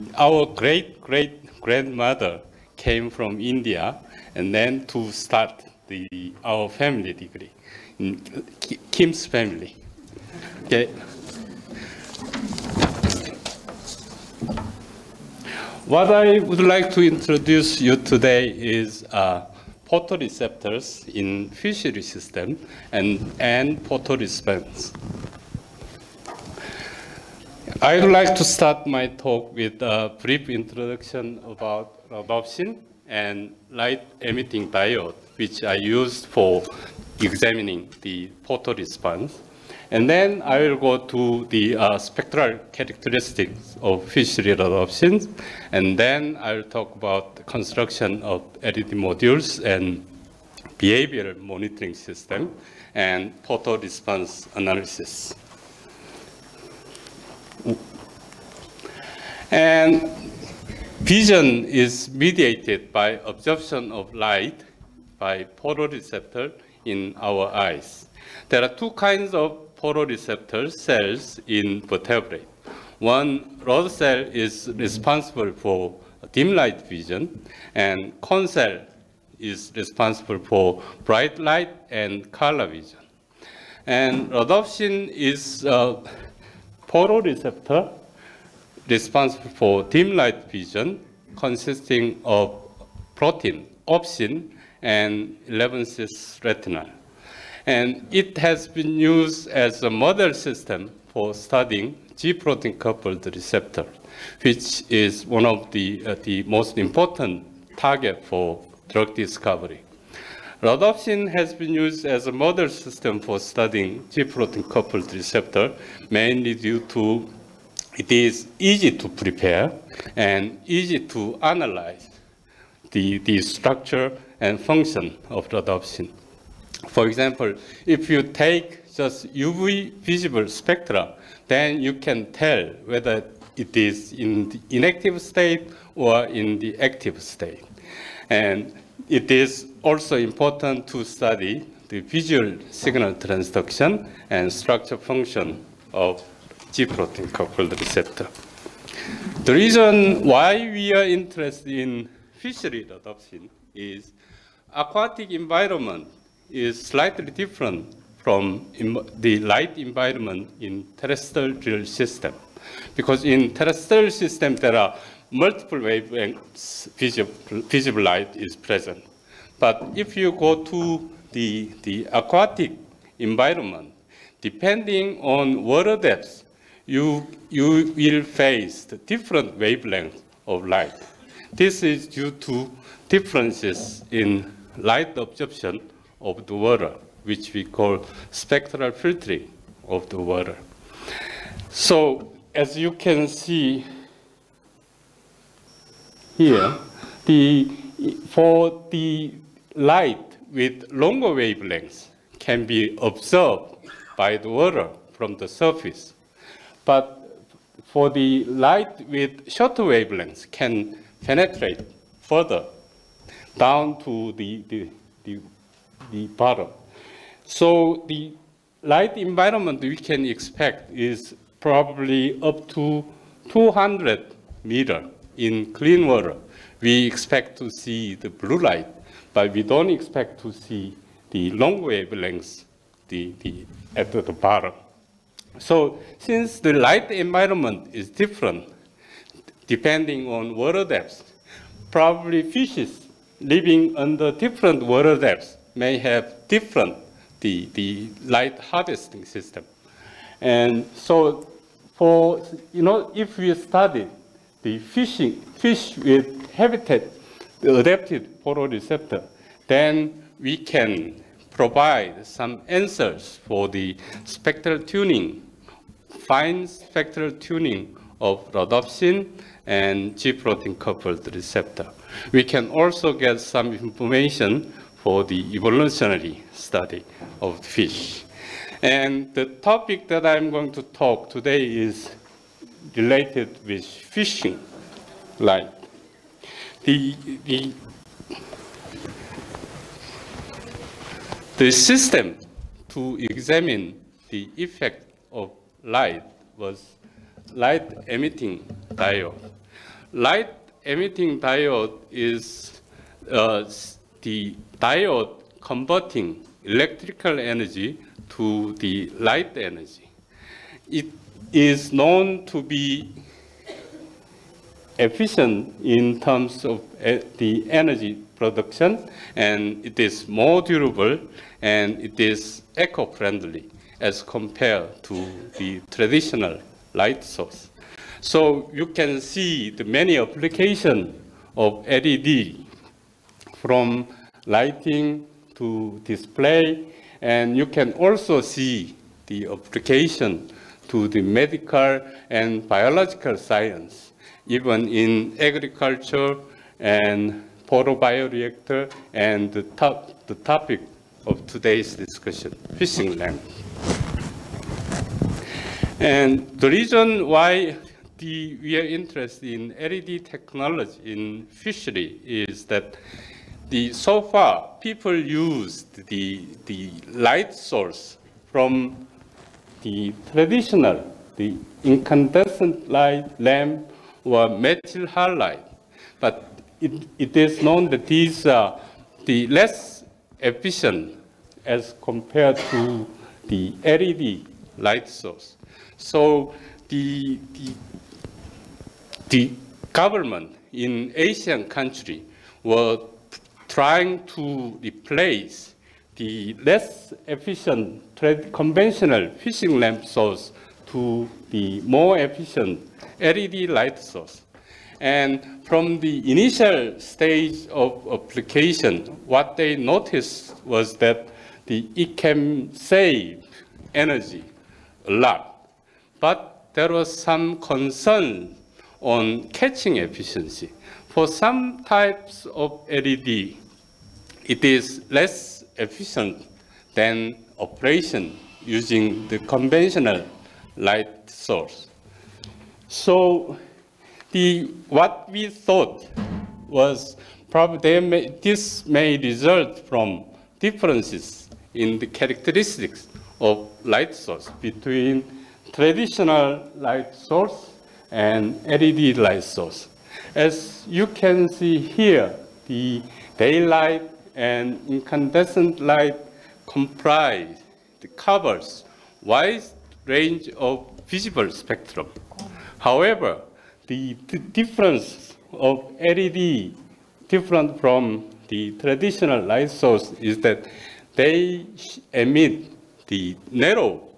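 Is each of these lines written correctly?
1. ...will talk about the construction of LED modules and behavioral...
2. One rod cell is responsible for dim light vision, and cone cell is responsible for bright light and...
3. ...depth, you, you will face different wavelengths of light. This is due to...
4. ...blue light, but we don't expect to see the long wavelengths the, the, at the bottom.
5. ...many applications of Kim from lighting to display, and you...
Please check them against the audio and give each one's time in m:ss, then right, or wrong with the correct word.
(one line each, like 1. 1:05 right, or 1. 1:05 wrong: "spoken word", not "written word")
1. 0:46 right
2. 1:12 right
3. 2:55 right
4. 3:48 right
5. 5:29 wrong: "LED", not "Kim".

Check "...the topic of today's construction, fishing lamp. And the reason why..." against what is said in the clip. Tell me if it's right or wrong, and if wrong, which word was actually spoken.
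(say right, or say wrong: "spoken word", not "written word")
wrong: "discussion", not "construction".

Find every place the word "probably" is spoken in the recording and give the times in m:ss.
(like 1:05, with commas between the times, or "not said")
3:41, 4:01, 7:17.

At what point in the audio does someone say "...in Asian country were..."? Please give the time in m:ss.
6:30.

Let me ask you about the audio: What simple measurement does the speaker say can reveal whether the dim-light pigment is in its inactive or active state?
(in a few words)
UV visible spectra.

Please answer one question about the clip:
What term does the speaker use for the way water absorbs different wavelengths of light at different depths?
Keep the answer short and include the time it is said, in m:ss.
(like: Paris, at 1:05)
spectral filtering, at 3:08.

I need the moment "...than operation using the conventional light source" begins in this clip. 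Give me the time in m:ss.
7:06.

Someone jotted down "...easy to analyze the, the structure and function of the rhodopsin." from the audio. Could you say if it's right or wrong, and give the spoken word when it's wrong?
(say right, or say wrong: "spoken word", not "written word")
right.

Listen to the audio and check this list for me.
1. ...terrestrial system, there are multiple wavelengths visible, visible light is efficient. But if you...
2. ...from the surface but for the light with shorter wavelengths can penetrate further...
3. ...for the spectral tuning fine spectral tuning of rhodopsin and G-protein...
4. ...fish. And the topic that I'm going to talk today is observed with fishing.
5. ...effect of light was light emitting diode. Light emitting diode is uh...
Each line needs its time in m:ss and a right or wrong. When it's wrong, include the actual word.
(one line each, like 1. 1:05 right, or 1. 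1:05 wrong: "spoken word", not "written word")
1. 2:43 wrong: "present", not "efficient"
2. 3:25 right
3. 4:23 right
4. 4:37 wrong: "related", not "observed"
5. 4:54 right.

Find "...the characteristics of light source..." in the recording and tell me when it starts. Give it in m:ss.
7:21.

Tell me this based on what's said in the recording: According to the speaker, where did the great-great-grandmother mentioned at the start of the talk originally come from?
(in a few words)
India.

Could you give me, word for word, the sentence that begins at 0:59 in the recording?
And Vision is mediated by absorption of light by photoreceptor in our eyes.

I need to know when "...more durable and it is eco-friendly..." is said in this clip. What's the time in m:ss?
5:20.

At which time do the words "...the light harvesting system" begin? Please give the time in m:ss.
4:07.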